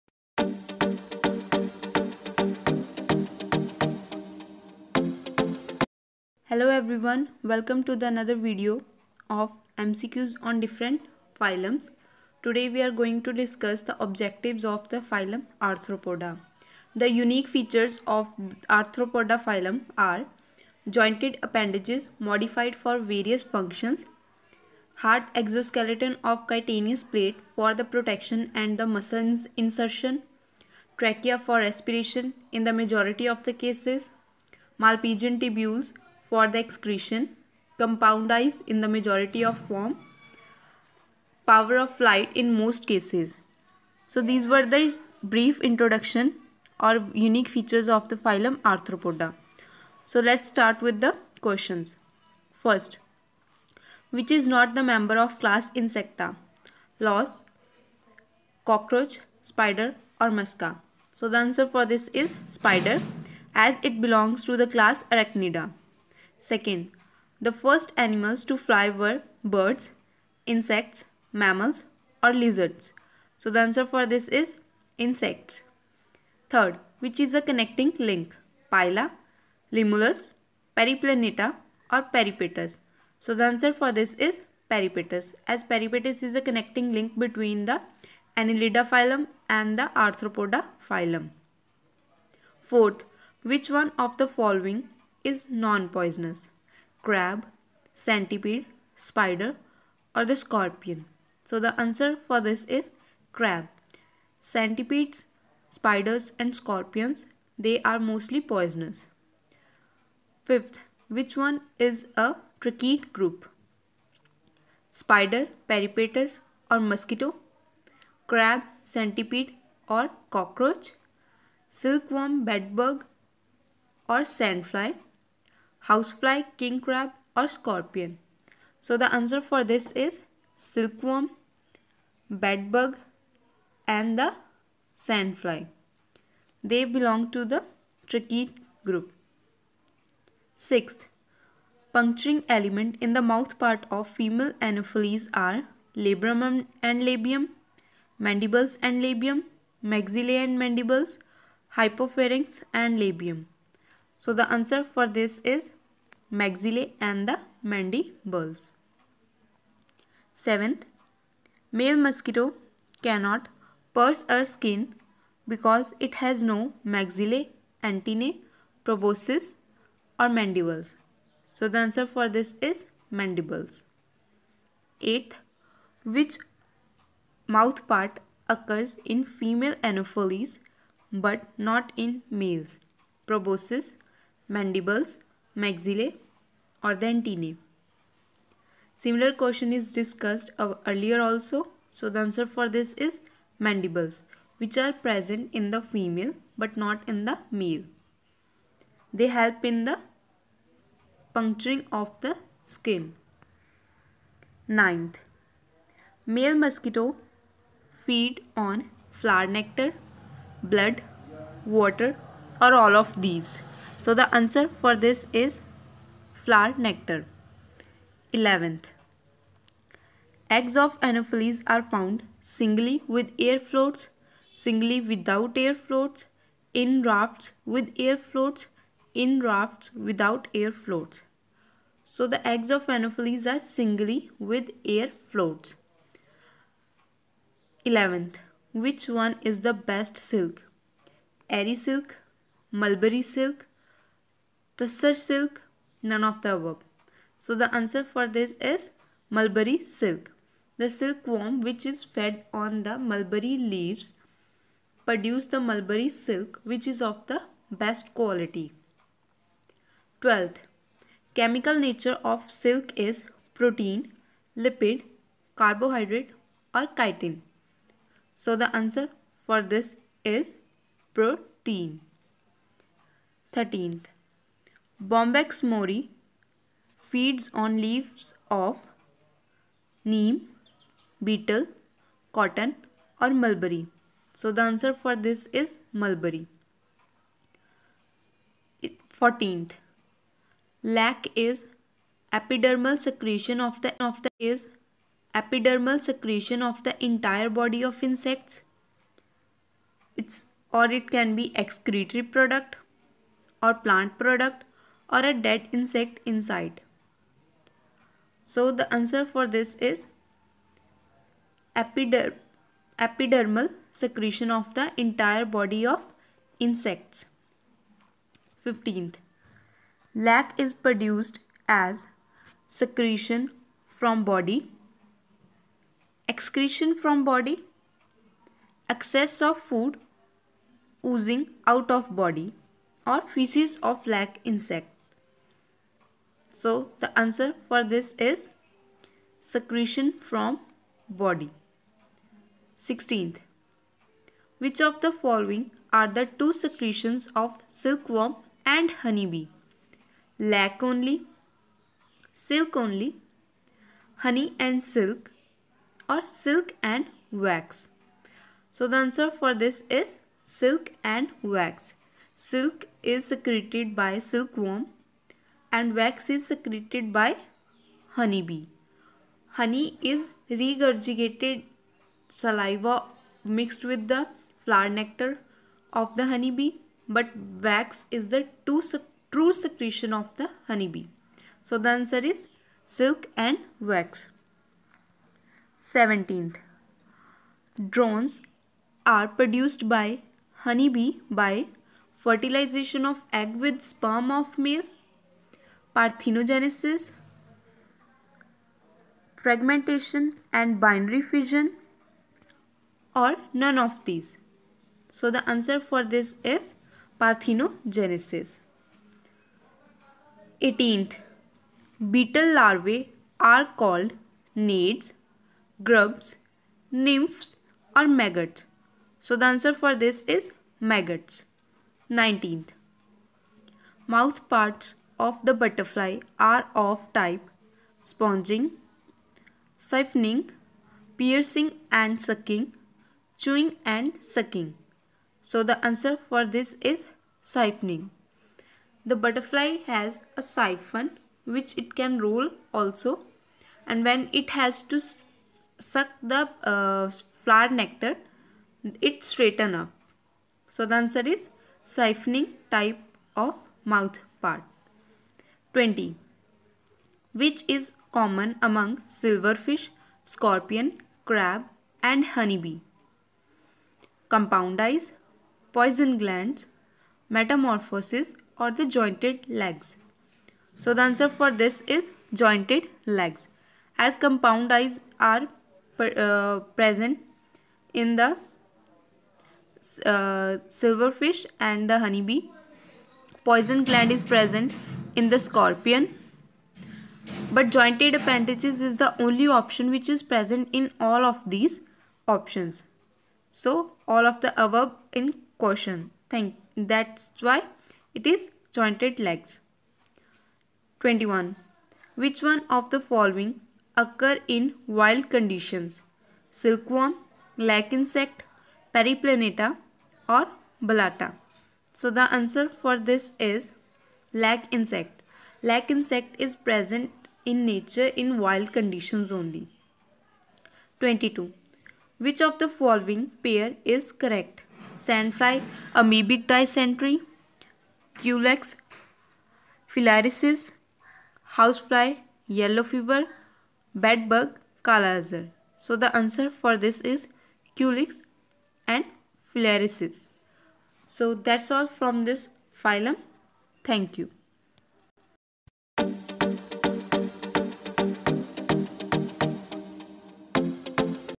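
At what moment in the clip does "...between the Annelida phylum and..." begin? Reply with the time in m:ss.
1:27.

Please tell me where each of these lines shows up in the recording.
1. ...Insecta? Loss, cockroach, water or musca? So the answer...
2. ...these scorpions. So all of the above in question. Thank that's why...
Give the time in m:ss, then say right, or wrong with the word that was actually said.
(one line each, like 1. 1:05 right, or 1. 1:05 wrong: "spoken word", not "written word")
1. 0:55 wrong: "spider", not "water"
2. 8:11 wrong: "options", not "scorpions".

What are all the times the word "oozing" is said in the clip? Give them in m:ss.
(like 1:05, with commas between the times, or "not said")
5:31.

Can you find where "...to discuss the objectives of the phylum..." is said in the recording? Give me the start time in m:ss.
0:13.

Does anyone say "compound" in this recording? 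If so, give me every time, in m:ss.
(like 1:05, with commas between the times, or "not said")
0:37, 7:44, 7:54.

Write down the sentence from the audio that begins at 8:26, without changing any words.
Silkworm, lac insect, periplaneta or Blatta.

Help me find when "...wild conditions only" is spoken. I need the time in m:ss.
8:38.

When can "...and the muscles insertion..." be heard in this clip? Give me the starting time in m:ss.
0:28.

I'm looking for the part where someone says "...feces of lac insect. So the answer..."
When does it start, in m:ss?
5:33.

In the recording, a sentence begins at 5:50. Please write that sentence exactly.
Lac only, silk only, honey and silk or silk and wax.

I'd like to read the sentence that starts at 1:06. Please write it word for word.
Second, the first animals to fly were birds, insects, mammals or lizards.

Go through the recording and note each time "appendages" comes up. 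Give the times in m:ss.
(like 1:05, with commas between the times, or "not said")
0:21, 8:08.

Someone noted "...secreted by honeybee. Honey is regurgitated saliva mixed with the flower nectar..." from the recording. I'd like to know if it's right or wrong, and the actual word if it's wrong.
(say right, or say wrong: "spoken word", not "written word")
right.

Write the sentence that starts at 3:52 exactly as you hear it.
So the eggs of Anopheles are singly with air floats.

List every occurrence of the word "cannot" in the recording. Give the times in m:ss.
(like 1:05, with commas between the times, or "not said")
2:43.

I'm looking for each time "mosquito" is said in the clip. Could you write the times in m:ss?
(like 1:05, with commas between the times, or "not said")
1:56, 2:42, 3:26.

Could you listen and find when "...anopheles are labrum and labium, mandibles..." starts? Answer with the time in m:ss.
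2:24.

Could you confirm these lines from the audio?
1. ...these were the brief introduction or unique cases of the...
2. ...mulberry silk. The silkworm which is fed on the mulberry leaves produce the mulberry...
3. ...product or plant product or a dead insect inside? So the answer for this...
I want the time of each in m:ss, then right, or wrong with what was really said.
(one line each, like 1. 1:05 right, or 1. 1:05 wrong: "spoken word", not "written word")
1. 0:44 wrong: "features", not "cases"
2. 4:09 right
3. 5:02 right.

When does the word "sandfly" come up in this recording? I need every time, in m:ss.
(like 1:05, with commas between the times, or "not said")
2:04, 2:14, 8:44.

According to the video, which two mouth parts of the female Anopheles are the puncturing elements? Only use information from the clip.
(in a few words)
Maxillae and mandibles.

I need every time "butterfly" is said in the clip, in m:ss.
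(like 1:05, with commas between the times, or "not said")
7:05, 7:19.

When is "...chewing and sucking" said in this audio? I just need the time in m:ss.
7:13.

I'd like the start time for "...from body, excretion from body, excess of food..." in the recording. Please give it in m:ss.
5:23.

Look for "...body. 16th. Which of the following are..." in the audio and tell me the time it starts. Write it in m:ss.
5:41.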